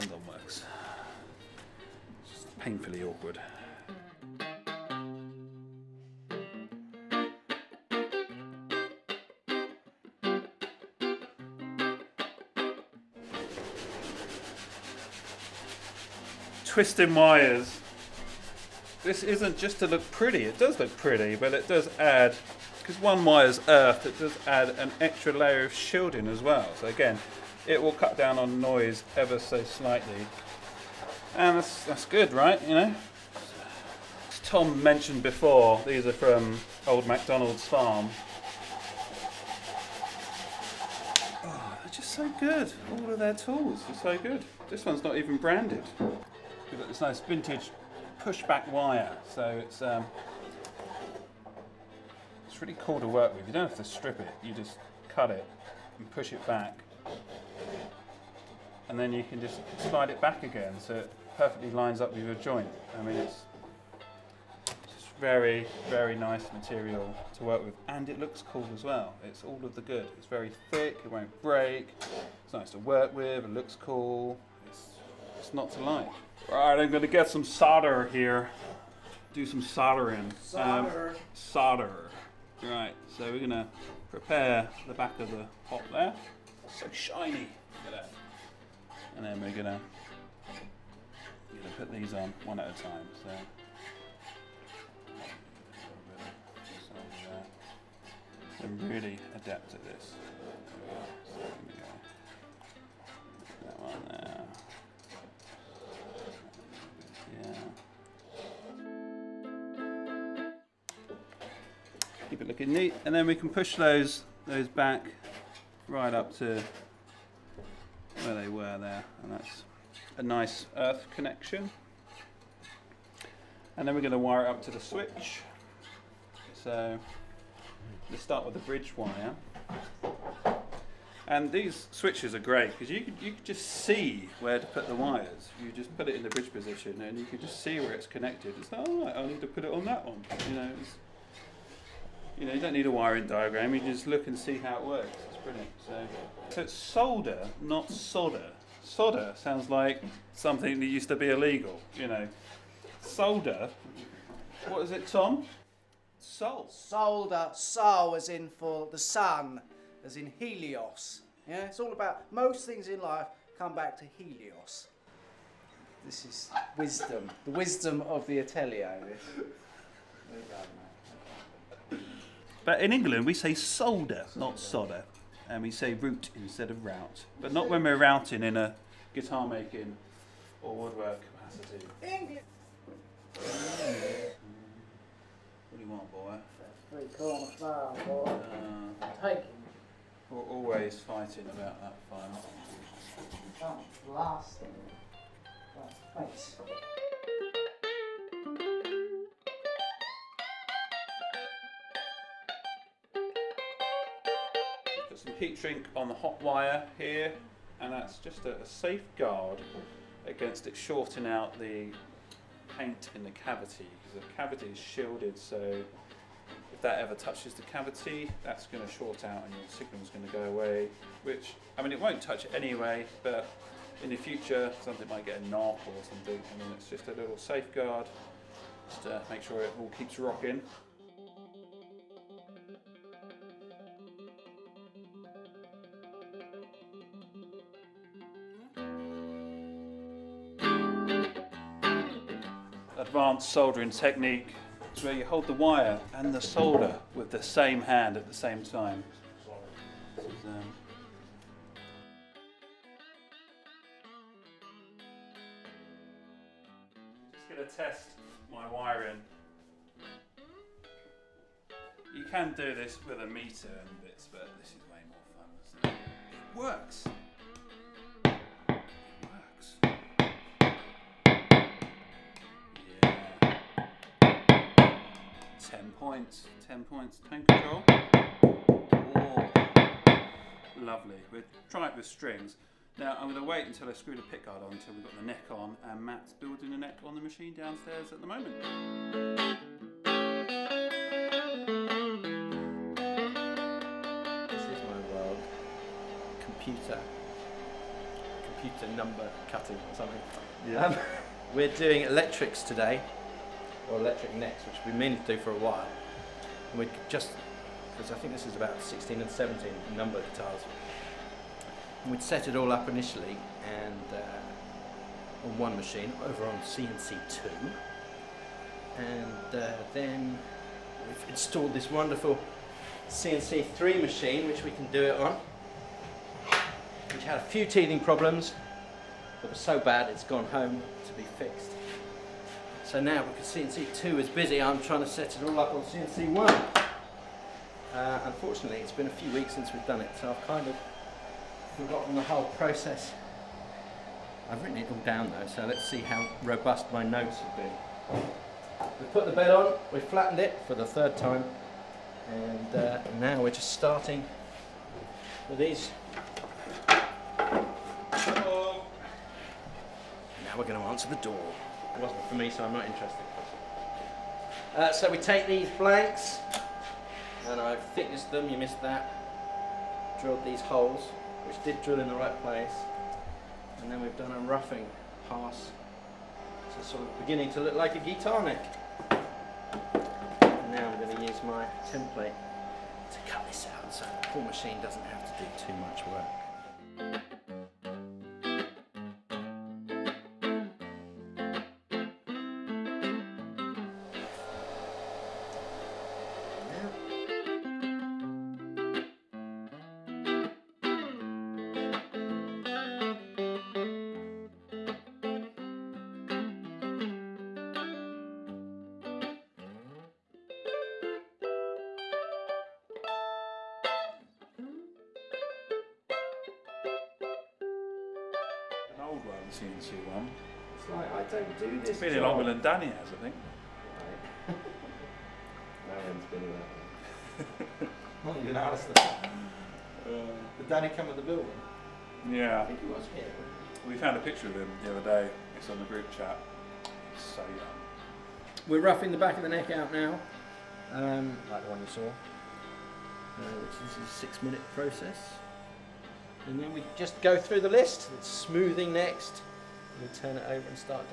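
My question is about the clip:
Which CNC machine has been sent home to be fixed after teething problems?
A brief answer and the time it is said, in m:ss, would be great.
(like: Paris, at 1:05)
CNC3, at 5:23.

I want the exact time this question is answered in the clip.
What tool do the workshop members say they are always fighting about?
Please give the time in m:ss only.
3:06.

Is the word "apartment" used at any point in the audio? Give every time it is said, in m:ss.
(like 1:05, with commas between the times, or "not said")
not said.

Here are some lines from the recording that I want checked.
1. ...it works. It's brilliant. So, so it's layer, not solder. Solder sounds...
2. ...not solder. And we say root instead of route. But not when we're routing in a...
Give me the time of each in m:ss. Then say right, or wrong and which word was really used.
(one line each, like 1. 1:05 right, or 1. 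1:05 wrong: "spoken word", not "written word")
1. 2:24 wrong: "solder", not "layer"
2. 2:54 right.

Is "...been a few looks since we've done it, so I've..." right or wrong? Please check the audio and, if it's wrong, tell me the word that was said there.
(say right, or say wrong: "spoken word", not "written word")
wrong: "weeks", not "looks".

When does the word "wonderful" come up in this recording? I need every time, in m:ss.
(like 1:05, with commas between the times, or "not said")
5:21.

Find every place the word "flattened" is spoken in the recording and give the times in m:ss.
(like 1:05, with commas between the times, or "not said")
5:50.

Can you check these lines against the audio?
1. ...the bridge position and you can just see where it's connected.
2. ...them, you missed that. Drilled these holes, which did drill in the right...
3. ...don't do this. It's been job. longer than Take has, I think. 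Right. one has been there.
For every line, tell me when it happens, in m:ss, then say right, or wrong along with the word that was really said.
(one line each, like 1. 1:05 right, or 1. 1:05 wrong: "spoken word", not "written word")
1. 2:16 right
2. 6:08 right
3. 7:01 wrong: "Danny", not "Take".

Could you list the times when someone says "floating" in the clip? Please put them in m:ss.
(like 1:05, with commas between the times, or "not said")
not said.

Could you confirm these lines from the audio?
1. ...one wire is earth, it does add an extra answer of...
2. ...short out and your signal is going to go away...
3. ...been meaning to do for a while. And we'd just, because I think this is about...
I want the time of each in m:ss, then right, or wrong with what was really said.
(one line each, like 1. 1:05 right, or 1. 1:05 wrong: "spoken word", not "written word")
1. 0:22 wrong: "layer", not "answer"
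2. 3:38 right
3. 5:04 right.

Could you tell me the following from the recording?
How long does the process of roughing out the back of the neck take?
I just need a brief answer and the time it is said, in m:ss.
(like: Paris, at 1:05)
6 minutes, at 7:24.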